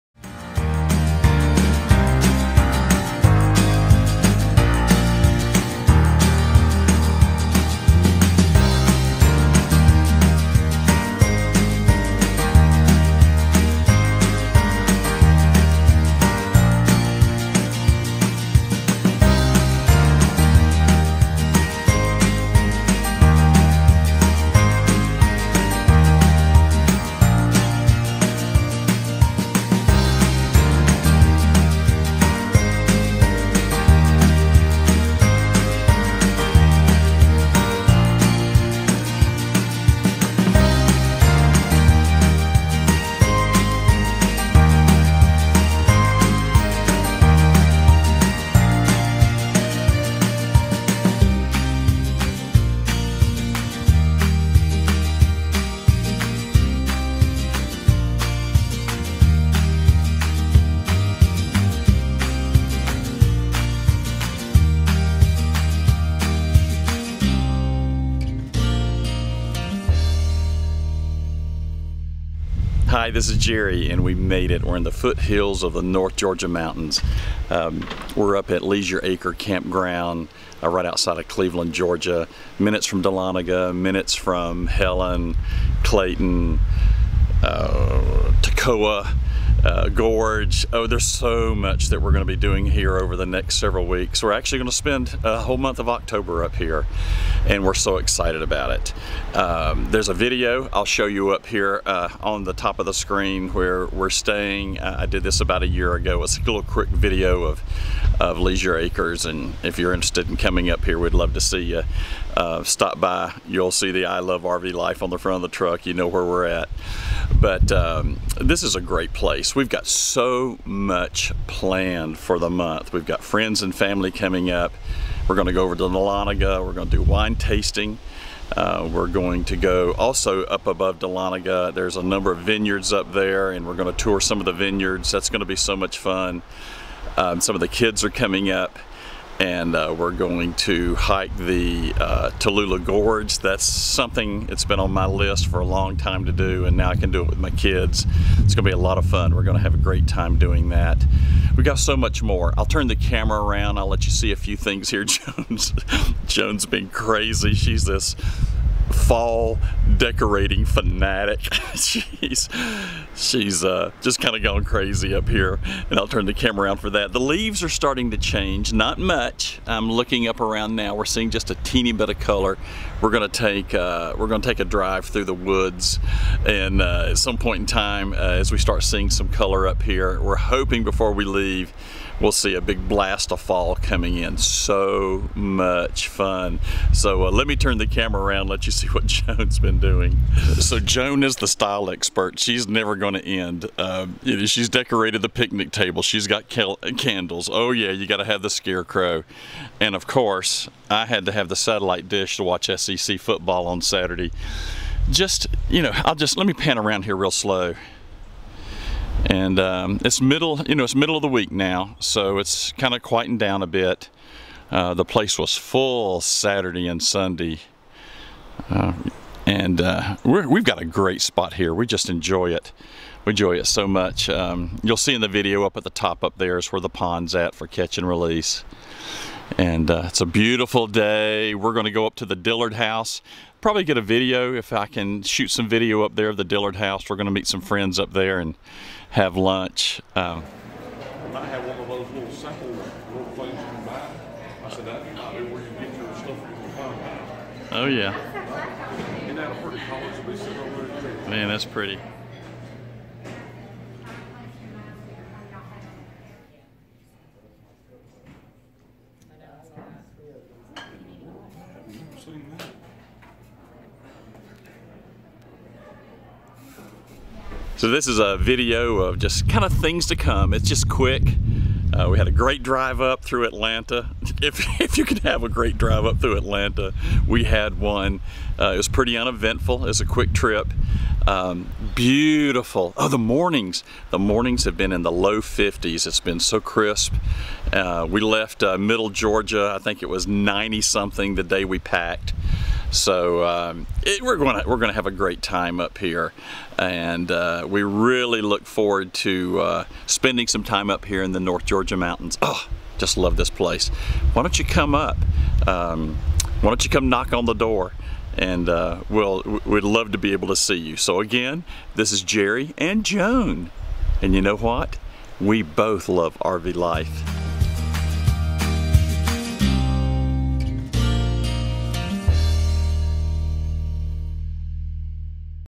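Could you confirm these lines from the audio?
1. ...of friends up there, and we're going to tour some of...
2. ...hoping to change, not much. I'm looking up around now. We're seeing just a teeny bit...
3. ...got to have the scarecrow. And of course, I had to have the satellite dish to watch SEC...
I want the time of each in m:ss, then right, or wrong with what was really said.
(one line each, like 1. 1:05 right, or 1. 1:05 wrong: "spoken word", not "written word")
1. 2:12 wrong: "vineyards", not "friends"
2. 2:47 wrong: "starting", not "hoping"
3. 3:18 right.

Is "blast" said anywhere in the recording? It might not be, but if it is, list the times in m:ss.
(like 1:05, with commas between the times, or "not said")
3:02.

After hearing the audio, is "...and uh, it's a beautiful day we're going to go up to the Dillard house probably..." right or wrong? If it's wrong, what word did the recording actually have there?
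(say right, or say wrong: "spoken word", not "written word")
right.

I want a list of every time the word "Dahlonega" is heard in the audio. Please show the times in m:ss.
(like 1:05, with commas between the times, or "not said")
1:23, 2:05, 2:10.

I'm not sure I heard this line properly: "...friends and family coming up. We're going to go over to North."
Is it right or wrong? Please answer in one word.
wrong.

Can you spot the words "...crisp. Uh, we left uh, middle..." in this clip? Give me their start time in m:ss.
4:46.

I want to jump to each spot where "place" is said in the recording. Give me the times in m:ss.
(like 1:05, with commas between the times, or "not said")
1:59, 3:35, 5:03.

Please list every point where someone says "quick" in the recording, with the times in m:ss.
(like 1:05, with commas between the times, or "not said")
1:46, 4:30, 4:40.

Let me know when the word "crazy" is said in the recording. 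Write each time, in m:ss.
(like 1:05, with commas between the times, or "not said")
2:36, 2:44.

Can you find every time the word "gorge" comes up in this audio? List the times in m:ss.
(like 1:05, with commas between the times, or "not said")
1:29, 2:22.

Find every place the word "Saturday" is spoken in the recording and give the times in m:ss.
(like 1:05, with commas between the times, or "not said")
3:23, 3:36.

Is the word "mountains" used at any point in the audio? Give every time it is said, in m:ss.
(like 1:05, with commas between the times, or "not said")
1:16, 5:01.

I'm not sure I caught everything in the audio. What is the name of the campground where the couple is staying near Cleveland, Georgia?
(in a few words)
Leisure Acre Campground.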